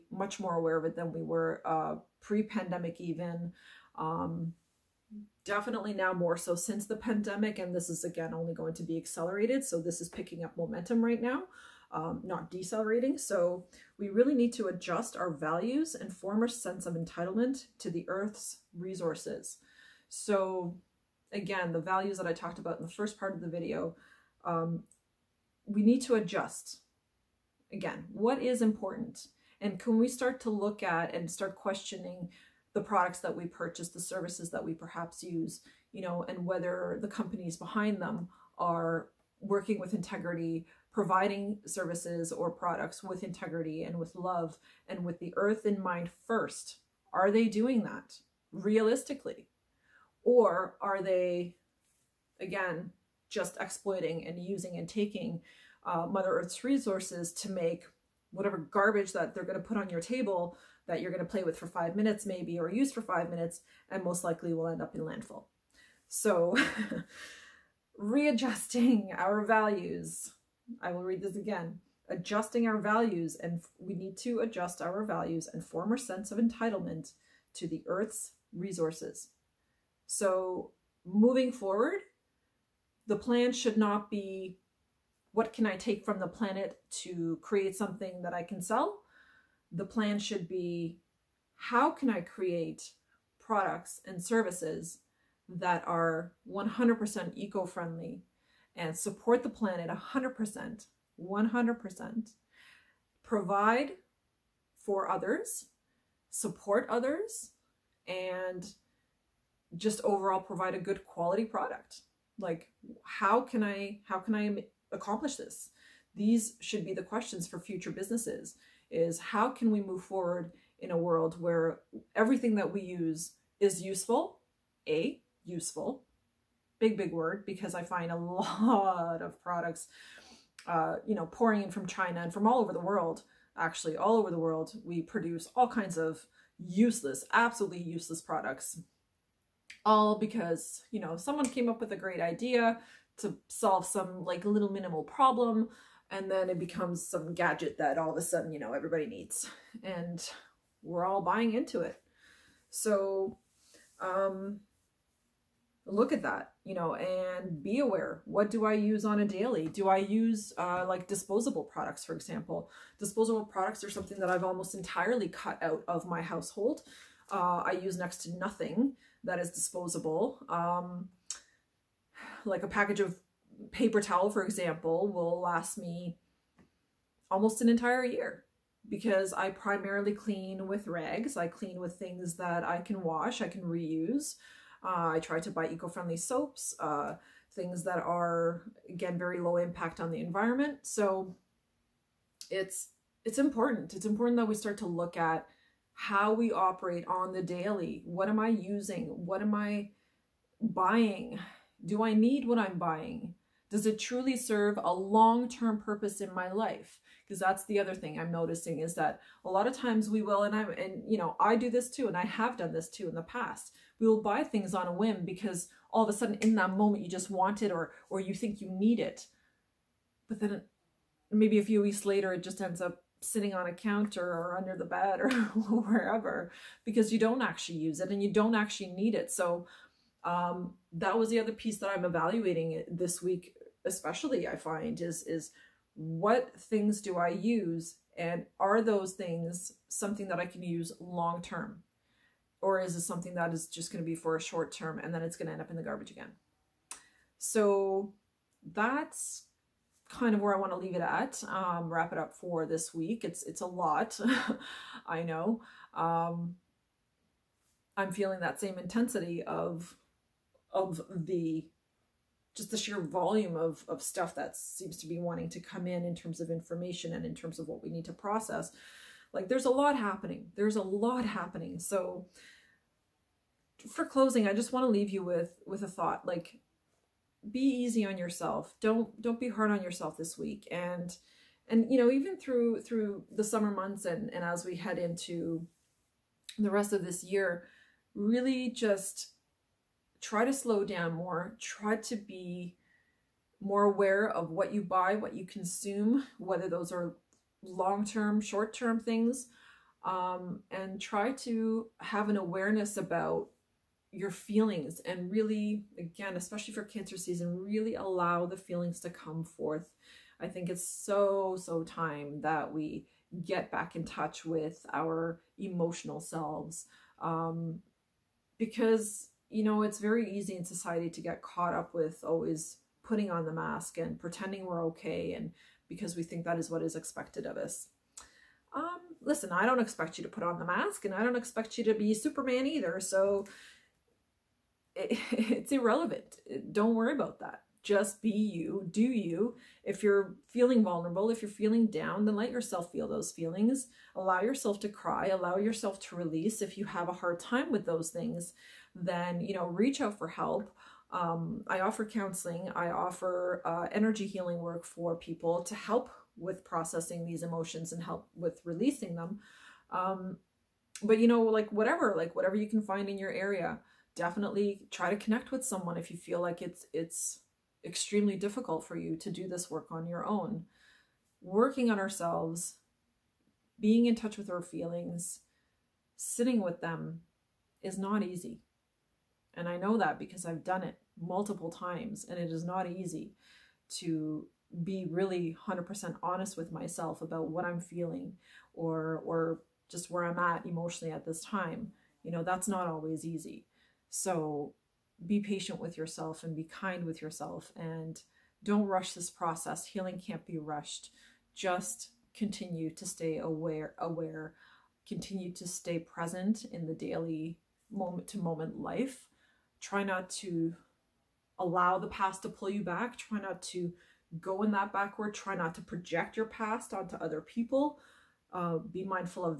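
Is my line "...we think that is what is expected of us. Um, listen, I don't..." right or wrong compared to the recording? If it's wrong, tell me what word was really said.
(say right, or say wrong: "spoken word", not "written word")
right.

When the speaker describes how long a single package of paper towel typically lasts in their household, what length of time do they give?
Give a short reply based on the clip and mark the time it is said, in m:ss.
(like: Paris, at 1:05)
almost an entire year, at 2:57.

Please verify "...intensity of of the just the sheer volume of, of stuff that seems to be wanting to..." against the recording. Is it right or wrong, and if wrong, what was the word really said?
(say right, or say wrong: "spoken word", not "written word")
right.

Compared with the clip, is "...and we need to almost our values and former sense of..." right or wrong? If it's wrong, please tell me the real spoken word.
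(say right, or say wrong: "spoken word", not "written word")
wrong: "adjust", not "almost".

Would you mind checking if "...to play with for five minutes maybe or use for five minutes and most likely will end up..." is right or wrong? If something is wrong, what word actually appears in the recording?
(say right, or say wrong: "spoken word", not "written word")
right.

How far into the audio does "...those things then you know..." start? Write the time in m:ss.
5:47.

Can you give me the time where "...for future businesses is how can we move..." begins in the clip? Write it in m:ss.
1:57.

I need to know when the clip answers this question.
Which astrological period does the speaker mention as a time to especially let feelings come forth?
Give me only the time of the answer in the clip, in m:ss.
5:06.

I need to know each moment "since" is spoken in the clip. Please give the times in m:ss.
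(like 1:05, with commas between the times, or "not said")
0:06.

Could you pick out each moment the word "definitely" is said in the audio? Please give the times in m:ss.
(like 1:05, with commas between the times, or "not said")
0:05, 6:04.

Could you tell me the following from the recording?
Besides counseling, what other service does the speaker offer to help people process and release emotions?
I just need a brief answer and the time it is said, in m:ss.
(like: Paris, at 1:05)
energy healing work, at 5:53.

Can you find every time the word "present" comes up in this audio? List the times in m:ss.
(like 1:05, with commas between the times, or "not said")
6:45.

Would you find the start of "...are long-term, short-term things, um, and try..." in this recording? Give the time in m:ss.
4:56.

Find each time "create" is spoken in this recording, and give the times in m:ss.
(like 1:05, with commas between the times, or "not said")
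1:27, 1:32.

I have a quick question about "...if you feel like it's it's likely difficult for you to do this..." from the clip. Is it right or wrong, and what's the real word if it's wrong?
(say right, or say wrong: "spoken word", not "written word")
wrong: "extremely", not "likely".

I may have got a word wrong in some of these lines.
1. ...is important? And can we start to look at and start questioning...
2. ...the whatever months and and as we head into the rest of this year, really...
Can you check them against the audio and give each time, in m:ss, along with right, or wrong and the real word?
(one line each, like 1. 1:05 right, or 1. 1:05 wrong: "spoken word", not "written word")
1. 0:28 right
2. 4:43 wrong: "summer", not "whatever".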